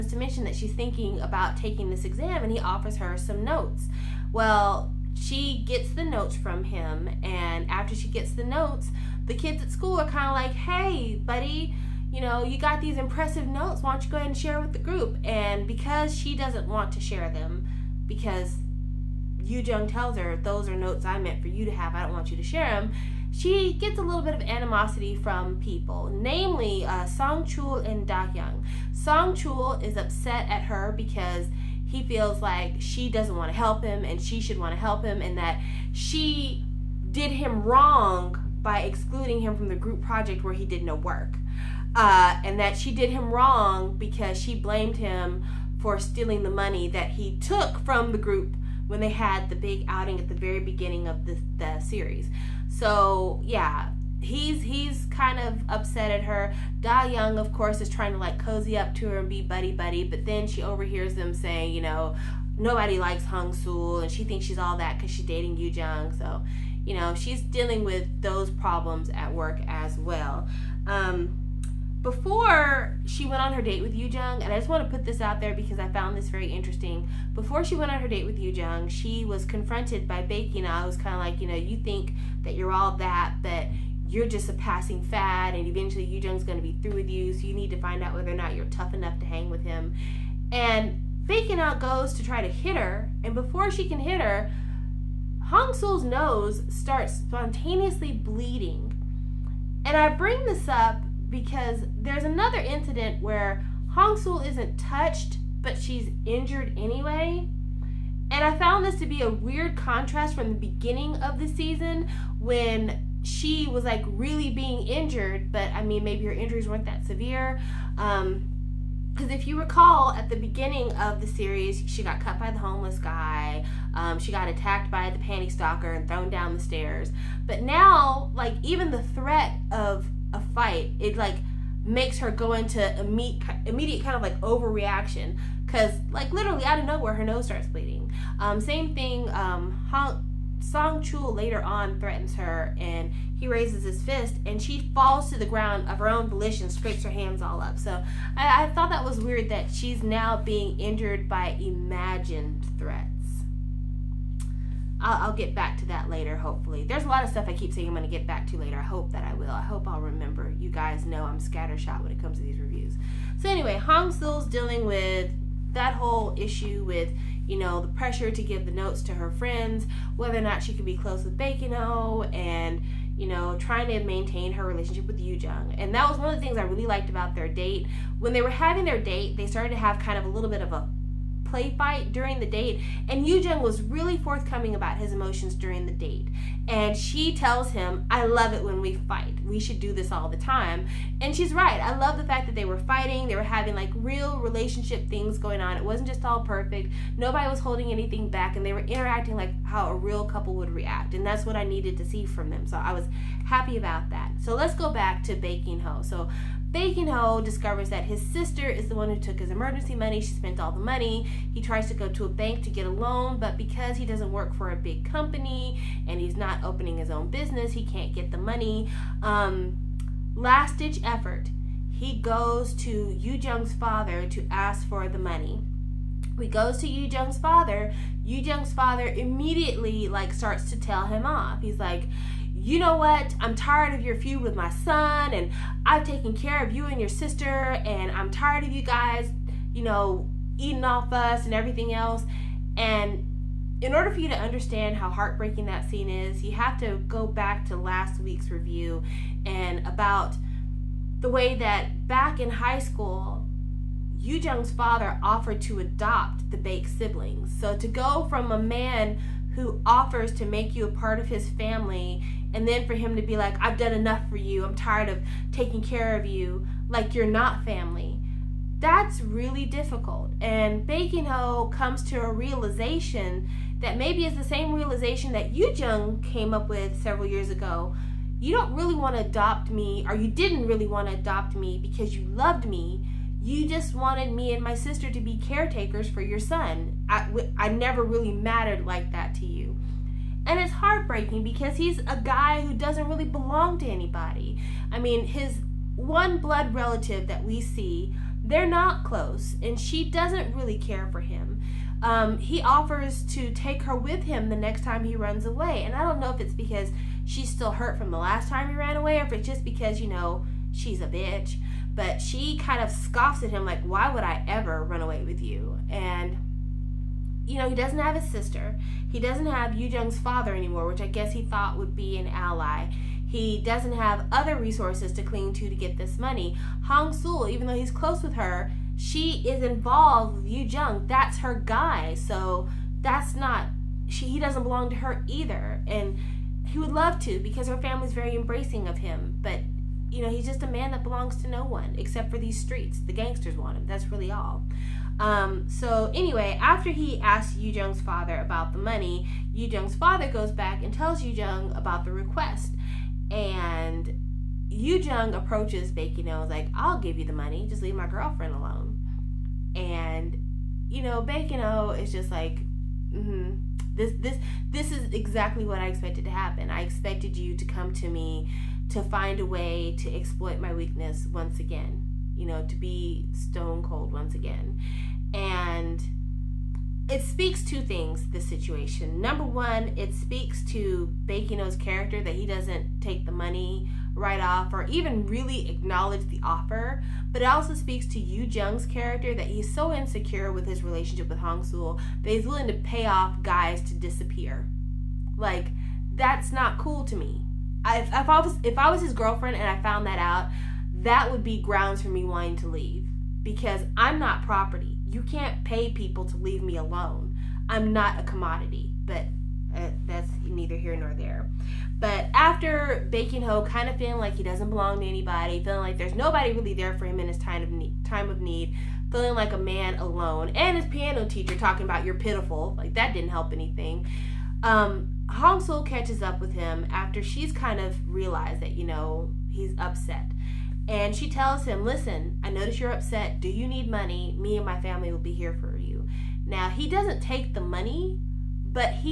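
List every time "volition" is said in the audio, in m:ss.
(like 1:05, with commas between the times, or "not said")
2:26.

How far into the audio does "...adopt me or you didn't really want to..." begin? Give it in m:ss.
4:39.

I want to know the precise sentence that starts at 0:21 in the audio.
I don't want you to share them.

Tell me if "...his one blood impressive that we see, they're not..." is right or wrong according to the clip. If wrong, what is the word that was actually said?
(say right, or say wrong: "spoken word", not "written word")
wrong: "relative", not "impressive".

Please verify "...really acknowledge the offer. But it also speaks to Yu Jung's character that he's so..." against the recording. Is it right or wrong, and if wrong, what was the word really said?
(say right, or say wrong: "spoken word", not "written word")
right.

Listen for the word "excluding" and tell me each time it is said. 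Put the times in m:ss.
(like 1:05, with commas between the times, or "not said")
0:38.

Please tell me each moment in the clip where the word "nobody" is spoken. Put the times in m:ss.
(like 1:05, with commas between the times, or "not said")
1:02, 3:17, 6:56.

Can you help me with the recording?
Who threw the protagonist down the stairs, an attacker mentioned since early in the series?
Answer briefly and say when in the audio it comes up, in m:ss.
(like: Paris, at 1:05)
The panty stalker, at 2:05.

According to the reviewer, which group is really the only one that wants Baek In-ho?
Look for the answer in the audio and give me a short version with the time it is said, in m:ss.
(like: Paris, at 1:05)
The gangsters, at 5:42.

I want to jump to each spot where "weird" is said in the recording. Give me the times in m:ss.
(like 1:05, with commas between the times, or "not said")
1:49, 2:29.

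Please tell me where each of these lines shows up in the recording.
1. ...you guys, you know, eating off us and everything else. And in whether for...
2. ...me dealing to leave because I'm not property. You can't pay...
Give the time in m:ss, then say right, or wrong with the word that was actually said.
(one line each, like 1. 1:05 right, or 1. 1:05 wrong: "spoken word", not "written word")
1. 3:58 wrong: "order", not "whether"
2. 6:42 wrong: "wanting", not "dealing".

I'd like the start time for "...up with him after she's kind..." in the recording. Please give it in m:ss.
7:06.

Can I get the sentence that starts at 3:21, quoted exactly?
And that's what I needed to see from them.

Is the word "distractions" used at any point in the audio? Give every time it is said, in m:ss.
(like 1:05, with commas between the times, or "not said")
not said.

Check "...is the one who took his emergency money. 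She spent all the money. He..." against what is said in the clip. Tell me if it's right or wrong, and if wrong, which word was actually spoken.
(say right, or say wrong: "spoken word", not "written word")
right.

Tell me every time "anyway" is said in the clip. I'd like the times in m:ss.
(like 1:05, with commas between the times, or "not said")
1:46, 2:43, 5:46.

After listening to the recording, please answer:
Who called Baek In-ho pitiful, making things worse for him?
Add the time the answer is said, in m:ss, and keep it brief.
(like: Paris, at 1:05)
His piano teacher, at 7:00.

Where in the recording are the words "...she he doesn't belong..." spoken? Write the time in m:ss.
5:34.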